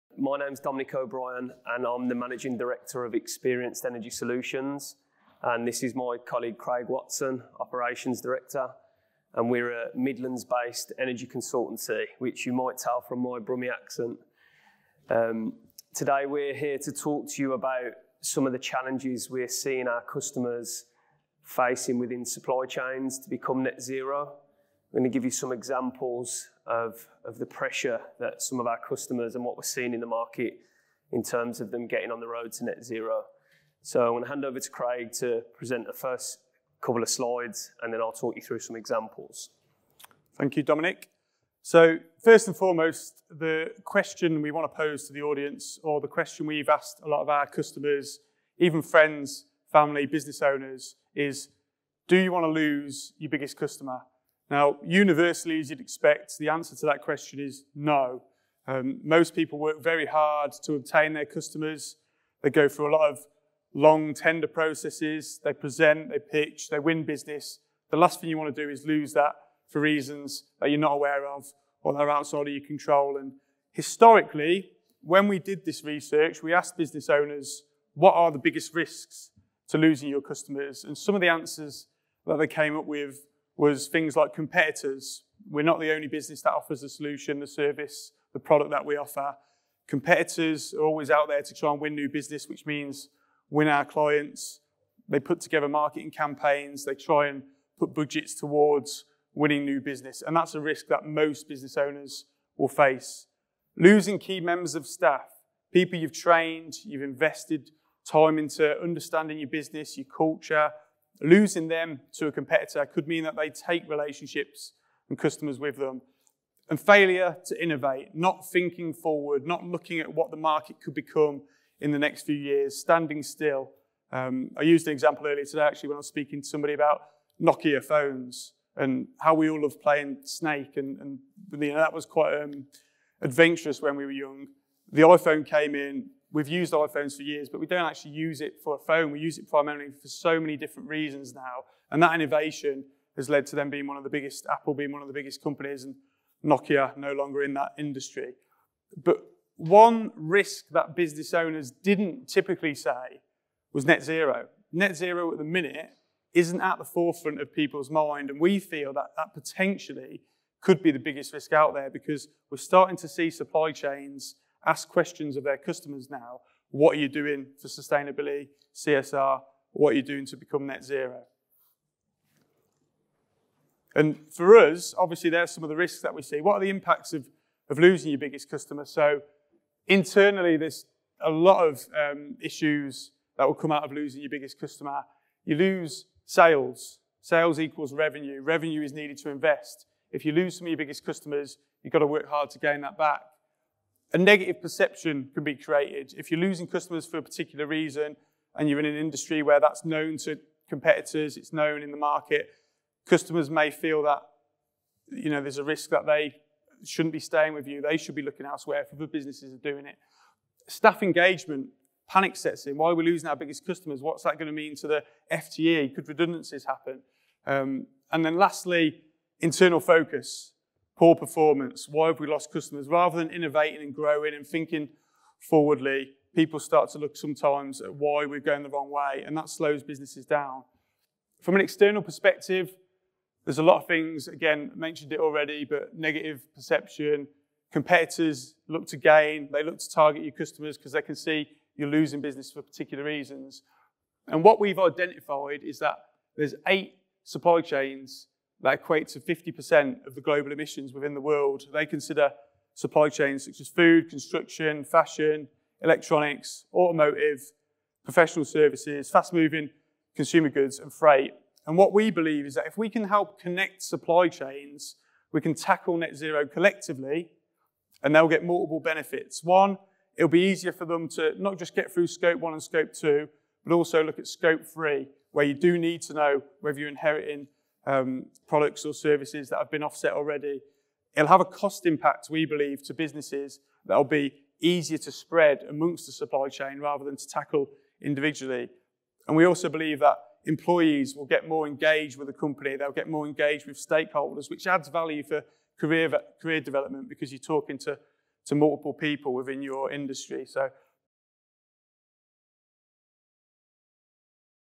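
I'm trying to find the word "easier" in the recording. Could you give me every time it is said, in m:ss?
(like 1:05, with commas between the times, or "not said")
4:30, 4:44.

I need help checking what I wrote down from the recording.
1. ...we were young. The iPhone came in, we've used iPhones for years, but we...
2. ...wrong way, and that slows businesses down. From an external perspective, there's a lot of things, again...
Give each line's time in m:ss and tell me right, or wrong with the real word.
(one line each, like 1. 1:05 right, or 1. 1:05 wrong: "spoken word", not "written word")
1. 2:13 right
2. 3:48 right.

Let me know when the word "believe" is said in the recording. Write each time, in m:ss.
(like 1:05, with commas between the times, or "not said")
4:22, 4:42, 4:49.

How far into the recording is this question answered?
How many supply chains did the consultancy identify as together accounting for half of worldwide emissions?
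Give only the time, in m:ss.
4:06.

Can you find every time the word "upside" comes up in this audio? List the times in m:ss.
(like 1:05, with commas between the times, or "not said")
not said.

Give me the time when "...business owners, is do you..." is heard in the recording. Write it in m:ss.
0:50.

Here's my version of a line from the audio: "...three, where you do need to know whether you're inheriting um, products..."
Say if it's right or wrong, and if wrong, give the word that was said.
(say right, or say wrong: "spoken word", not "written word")
right.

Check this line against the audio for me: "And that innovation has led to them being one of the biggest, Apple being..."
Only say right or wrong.
right.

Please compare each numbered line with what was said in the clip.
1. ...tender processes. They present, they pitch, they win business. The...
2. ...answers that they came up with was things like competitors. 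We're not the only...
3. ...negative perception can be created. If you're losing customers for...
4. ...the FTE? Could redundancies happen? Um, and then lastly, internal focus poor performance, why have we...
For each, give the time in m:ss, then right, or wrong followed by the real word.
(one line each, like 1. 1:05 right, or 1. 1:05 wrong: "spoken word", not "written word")
1. 1:04 right
2. 1:21 right
3. 3:14 right
4. 3:34 right.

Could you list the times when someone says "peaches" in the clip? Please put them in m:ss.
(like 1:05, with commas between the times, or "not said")
not said.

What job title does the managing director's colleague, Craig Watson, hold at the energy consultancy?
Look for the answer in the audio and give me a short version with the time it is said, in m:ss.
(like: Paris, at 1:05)
Operations Director, at 0:07.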